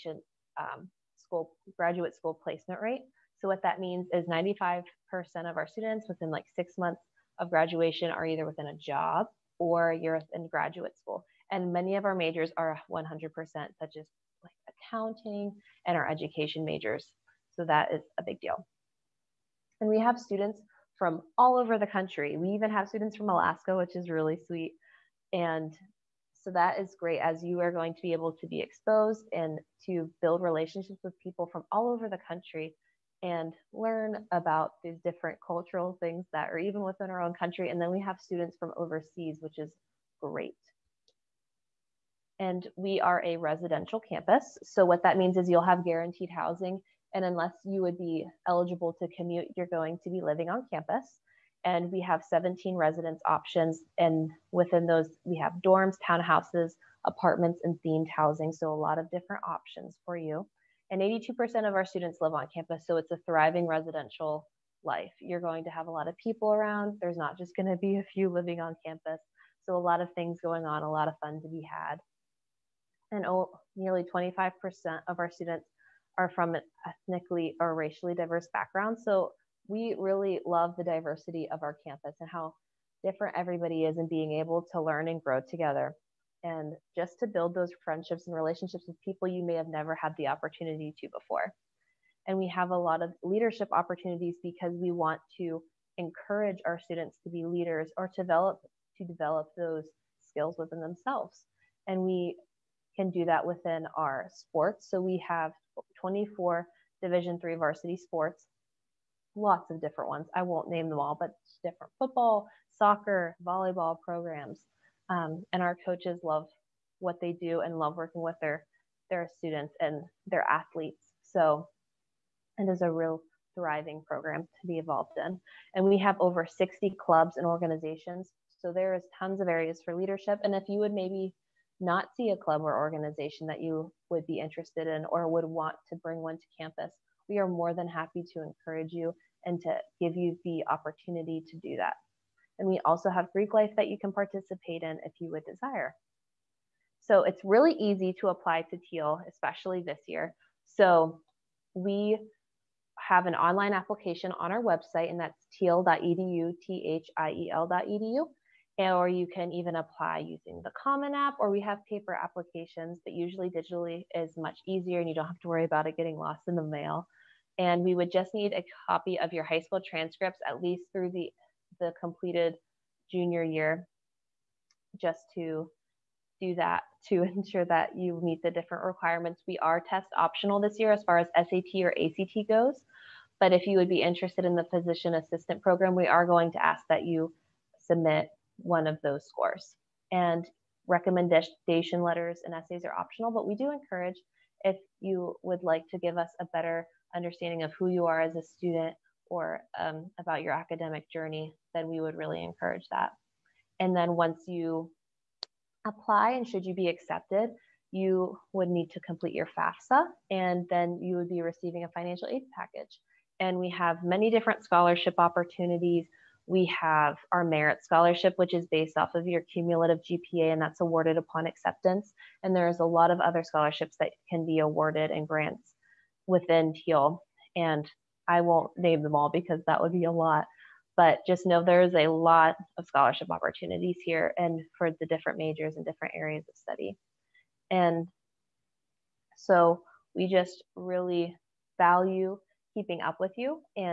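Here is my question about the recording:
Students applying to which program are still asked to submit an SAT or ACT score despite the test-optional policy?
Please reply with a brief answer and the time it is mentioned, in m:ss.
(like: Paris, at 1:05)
Physician assistant program, at 3:04.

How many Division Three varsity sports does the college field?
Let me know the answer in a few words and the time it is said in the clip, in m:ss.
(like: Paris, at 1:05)
24, at 1:46.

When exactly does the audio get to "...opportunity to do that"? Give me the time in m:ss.
2:20.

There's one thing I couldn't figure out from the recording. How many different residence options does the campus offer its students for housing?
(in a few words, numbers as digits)
17.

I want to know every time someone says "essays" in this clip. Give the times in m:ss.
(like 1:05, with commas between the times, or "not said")
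3:12.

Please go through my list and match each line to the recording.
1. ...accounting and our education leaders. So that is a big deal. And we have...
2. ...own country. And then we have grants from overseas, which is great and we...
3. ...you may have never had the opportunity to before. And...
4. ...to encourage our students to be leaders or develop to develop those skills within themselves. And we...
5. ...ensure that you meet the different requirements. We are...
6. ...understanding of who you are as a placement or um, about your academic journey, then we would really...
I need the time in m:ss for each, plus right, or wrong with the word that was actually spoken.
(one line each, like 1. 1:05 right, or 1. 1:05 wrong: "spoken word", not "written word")
1. 0:14 wrong: "majors", not "leaders"
2. 0:37 wrong: "students", not "grants"
3. 1:29 right
4. 1:35 right
5. 2:57 right
6. 3:17 wrong: "student", not "placement".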